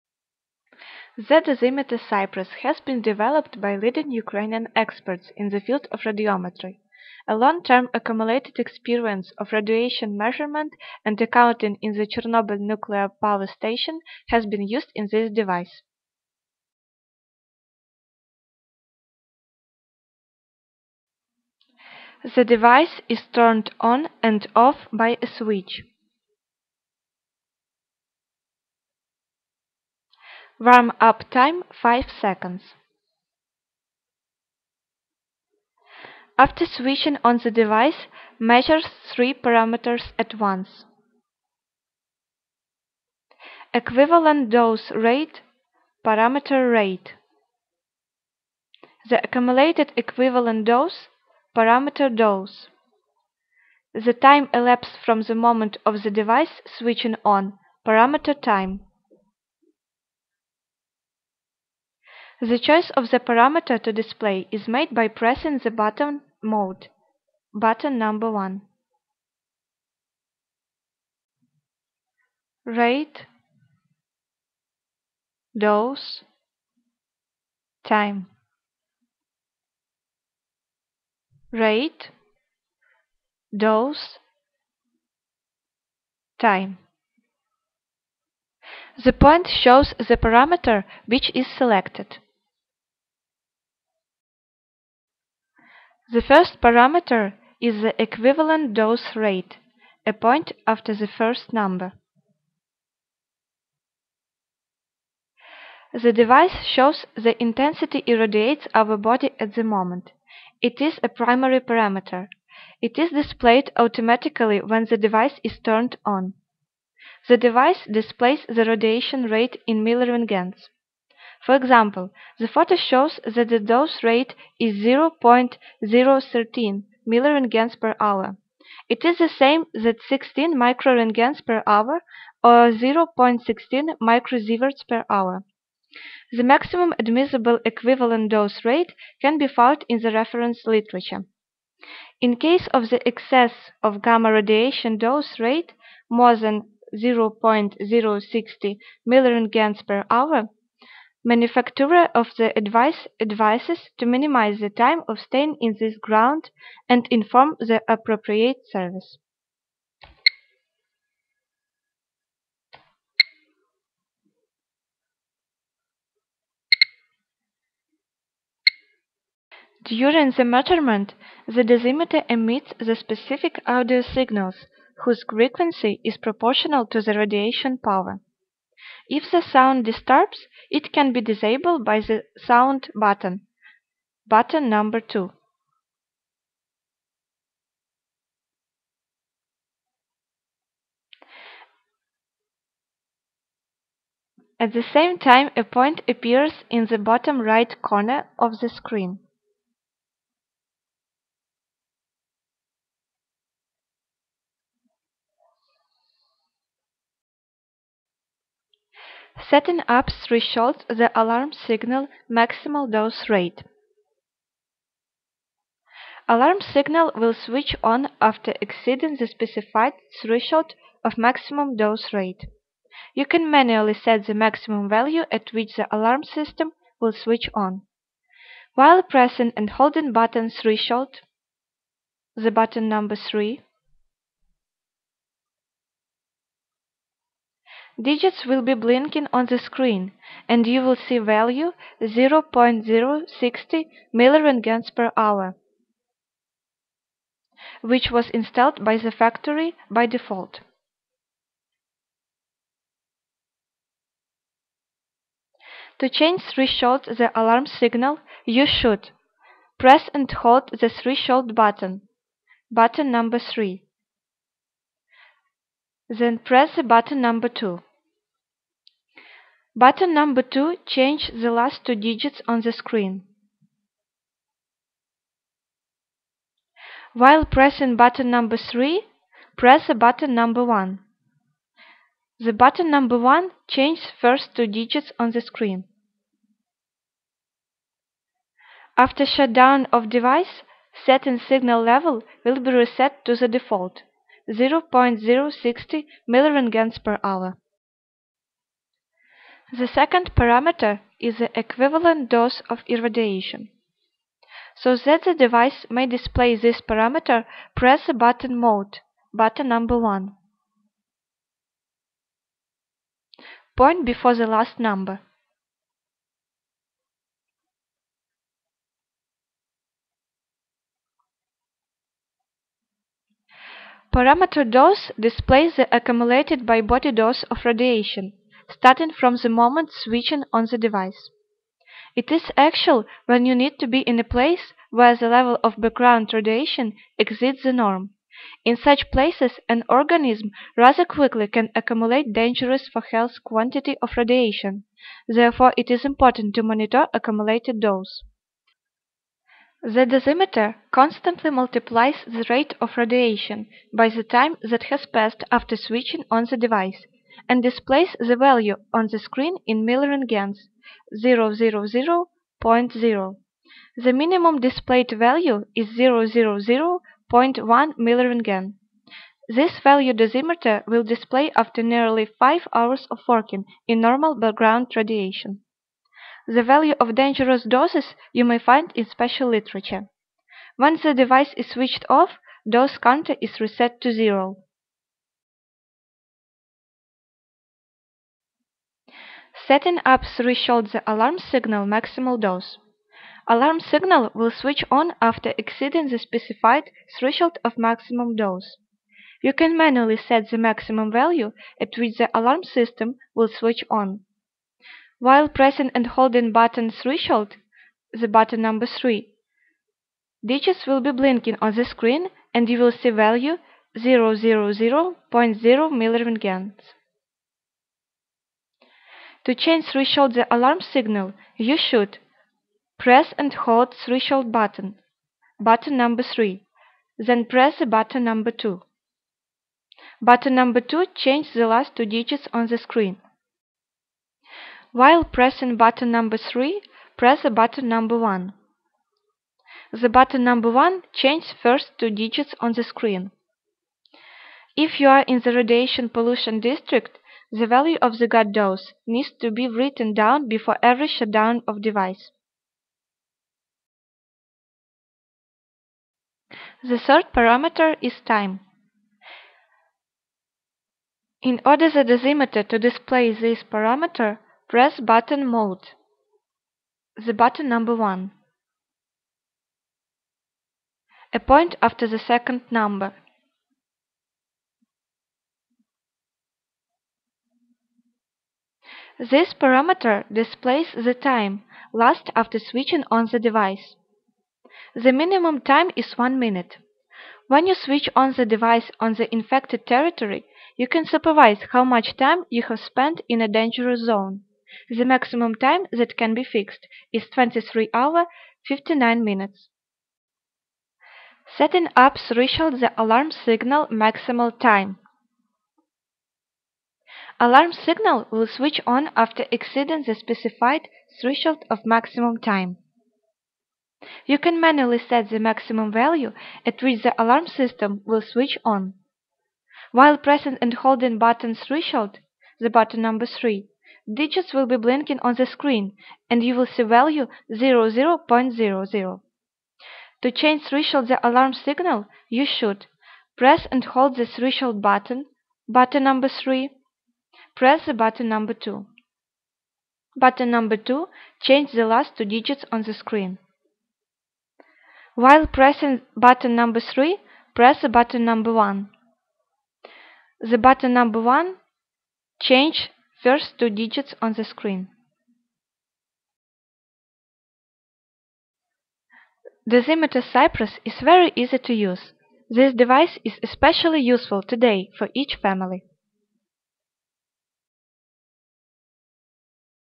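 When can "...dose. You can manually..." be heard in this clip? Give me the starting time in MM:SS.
06:38.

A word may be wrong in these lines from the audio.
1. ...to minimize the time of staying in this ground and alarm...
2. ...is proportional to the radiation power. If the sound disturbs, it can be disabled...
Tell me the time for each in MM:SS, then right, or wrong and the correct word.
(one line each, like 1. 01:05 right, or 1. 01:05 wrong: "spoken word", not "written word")
1. 02:33 wrong: "inform", not "alarm"
2. 02:56 right.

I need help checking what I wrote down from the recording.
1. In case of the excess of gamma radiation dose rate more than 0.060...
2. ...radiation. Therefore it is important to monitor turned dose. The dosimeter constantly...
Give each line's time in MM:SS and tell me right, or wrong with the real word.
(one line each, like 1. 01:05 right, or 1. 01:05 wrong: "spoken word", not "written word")
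1. 02:22 right
2. 05:44 wrong: "accumulated", not "turned".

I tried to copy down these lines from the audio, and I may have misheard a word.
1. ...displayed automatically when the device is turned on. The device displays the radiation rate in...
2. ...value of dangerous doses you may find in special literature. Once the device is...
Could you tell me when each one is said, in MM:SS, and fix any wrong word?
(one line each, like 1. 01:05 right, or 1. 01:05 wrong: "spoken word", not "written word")
1. 01:53 right
2. 06:16 right.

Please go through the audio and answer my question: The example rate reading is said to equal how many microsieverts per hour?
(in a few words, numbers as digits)
0.16.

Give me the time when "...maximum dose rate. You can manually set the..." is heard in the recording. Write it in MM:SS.
03:41.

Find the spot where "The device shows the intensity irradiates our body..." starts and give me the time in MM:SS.
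01:45.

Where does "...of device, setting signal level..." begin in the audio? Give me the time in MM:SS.
04:49.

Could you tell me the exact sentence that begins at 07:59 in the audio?
This parameter displays the time last after switching on the device.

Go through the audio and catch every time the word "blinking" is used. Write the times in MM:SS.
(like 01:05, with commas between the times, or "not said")
03:58, 06:51, 08:44.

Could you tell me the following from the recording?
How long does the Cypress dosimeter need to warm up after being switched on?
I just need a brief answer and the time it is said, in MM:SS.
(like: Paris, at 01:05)
5 seconds, at 00:31.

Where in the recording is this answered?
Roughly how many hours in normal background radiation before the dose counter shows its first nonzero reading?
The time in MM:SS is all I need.
06:12.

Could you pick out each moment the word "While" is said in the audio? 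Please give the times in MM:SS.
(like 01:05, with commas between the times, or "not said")
03:48, 04:37, 06:45, 07:14, 08:39, 09:05.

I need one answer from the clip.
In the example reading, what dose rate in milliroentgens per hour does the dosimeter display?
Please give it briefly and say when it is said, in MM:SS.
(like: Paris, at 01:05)
0.013, at 02:04.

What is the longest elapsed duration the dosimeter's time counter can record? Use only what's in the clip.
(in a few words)
23 hours 59 minutes.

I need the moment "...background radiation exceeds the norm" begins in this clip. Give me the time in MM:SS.
05:35.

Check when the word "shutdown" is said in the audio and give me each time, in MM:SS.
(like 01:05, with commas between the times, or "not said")
04:49, 07:31.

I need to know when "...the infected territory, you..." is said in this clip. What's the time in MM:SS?
08:09.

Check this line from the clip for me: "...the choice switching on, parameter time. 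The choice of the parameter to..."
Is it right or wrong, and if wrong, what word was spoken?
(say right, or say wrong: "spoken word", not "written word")
wrong: "device", not "choice".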